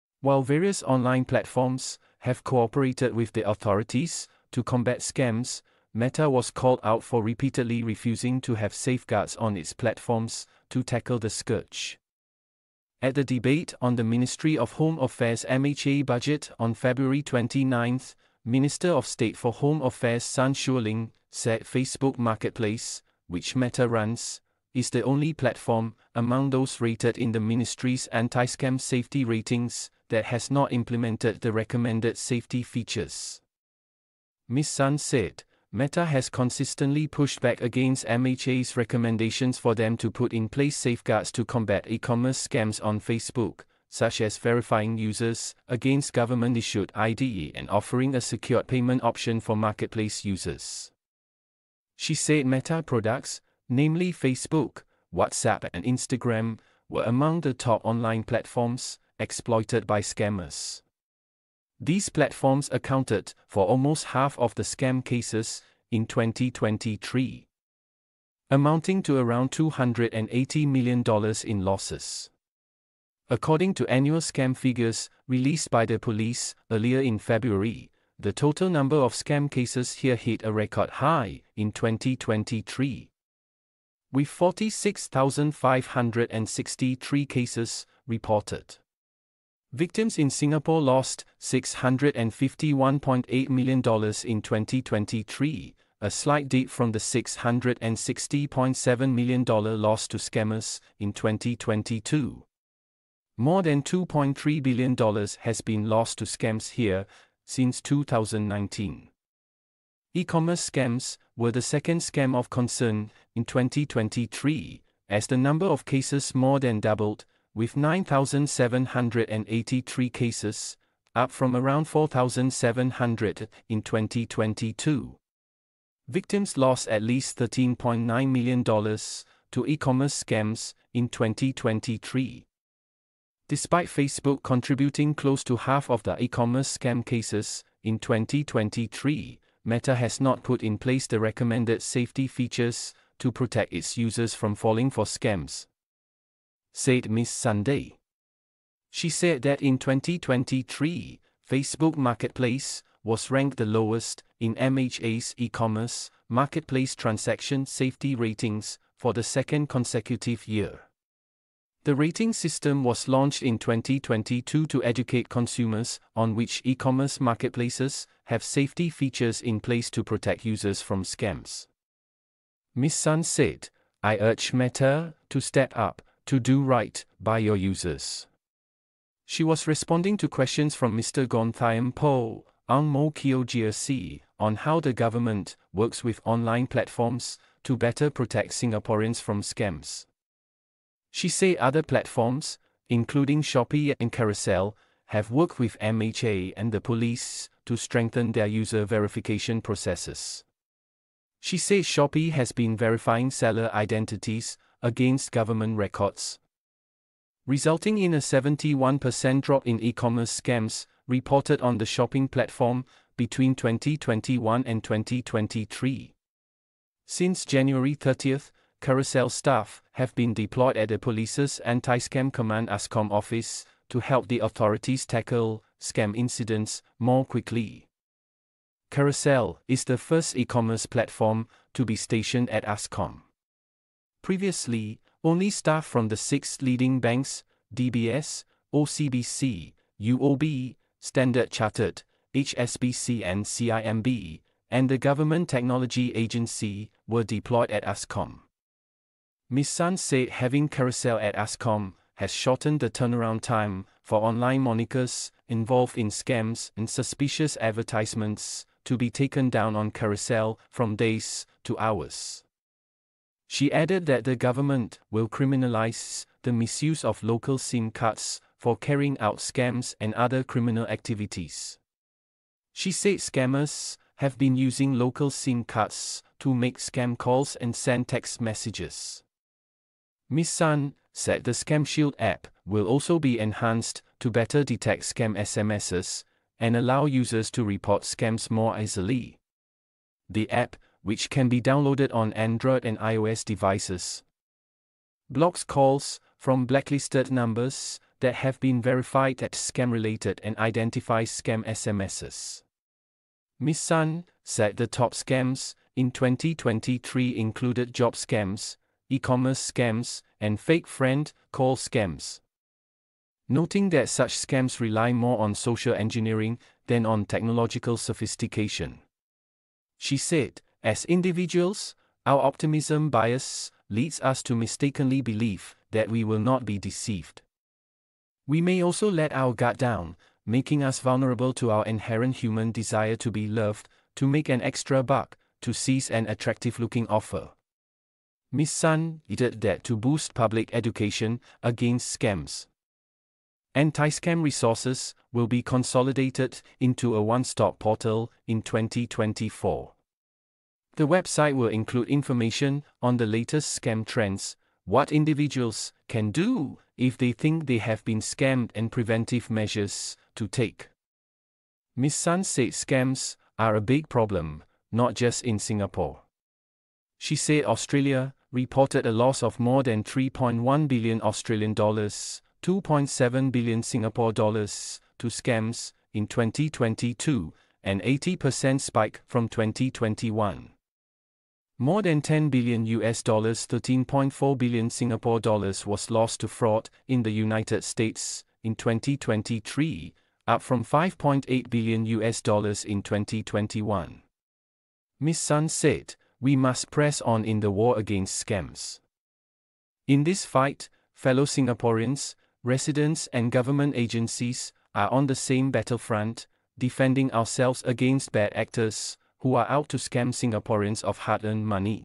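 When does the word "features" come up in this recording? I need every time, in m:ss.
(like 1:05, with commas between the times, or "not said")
0:32, 2:22, 2:48.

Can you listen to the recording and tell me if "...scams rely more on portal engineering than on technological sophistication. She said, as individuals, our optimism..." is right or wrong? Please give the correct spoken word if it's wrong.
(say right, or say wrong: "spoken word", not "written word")
wrong: "social", not "portal".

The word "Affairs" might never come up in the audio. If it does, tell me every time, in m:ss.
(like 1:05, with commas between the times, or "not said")
0:14, 0:19.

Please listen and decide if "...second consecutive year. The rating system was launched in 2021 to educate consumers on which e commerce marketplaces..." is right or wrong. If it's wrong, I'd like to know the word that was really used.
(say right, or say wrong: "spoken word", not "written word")
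wrong: "2022", not "2021".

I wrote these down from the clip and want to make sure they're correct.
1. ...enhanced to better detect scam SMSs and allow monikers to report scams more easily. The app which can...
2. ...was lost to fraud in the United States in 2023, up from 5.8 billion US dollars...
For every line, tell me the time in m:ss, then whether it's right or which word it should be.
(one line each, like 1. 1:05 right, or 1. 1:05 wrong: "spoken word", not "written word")
1. 4:43 wrong: "users", not "monikers"
2. 6:25 right.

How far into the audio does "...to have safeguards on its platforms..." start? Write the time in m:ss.
0:08.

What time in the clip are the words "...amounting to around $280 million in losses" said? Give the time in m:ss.
1:08.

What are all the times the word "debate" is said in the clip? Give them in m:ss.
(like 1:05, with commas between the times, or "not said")
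0:13.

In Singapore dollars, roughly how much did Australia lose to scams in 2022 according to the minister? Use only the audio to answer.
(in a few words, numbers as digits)
2.7 billion Singapore dollars.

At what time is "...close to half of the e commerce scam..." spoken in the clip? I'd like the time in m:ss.
2:15.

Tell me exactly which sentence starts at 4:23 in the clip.
She added that the government will criminalize the misuse of local SIM cards for carrying out scams and other criminal activities.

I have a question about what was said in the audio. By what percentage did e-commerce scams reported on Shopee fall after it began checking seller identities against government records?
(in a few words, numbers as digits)
71%.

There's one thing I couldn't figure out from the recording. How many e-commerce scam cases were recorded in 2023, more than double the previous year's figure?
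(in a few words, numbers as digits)
9,783.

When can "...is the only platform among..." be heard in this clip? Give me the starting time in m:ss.
0:24.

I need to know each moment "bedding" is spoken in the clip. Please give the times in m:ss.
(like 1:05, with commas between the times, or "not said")
not said.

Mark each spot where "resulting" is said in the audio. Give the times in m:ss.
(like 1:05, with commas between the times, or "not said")
3:27.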